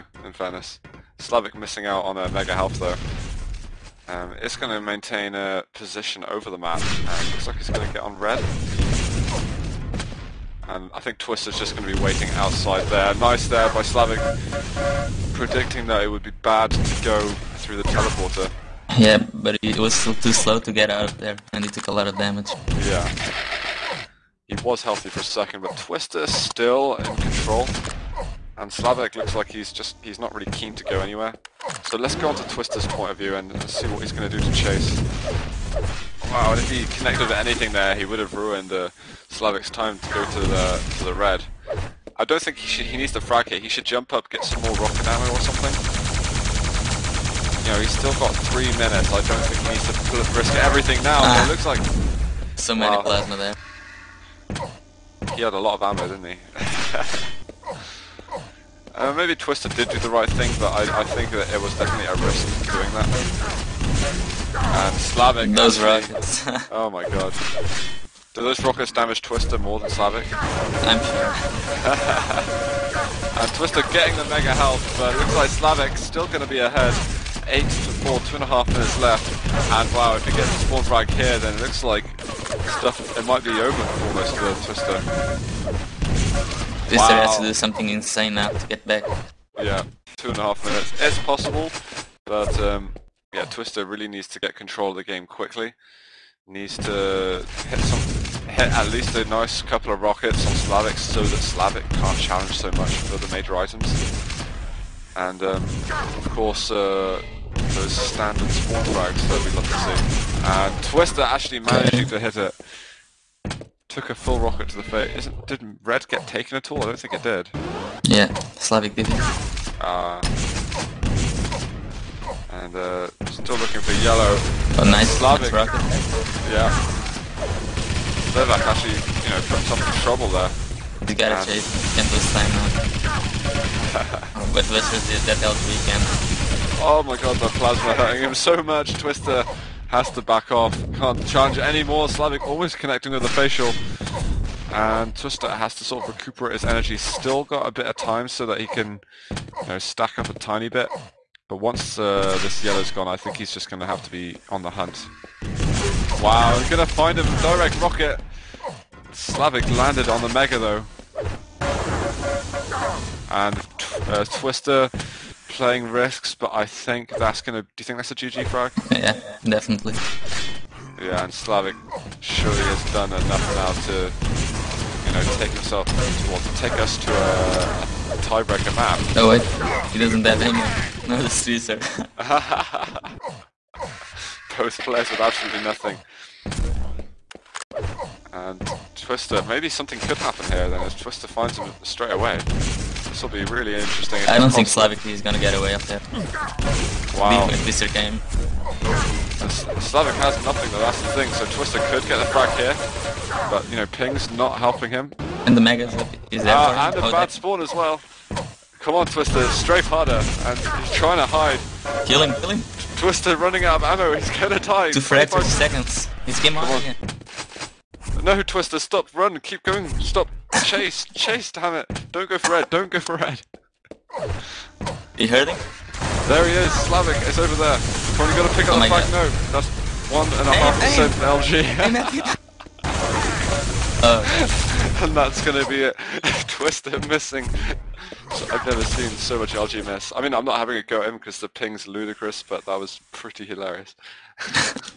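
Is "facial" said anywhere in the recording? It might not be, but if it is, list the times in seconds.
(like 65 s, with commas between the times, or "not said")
143 s.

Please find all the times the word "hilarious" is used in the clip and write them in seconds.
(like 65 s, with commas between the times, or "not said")
243 s.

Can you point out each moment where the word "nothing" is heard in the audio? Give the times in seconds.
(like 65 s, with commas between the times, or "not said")
185 s, 200 s.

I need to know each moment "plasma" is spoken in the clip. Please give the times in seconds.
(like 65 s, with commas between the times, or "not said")
53 s, 137 s.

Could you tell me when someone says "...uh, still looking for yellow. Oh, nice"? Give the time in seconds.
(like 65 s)
122 s.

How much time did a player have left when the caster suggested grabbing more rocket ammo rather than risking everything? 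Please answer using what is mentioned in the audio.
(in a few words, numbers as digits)
3 minutes.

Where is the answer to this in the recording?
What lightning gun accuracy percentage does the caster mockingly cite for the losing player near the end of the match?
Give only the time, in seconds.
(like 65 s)
230 s.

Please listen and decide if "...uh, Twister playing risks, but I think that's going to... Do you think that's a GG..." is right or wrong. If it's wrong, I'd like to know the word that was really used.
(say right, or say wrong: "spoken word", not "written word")
right.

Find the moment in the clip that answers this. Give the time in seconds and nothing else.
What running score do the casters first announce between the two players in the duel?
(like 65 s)
77 s.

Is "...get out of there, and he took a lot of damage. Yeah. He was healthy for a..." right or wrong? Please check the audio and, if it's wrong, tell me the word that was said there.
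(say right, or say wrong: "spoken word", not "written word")
right.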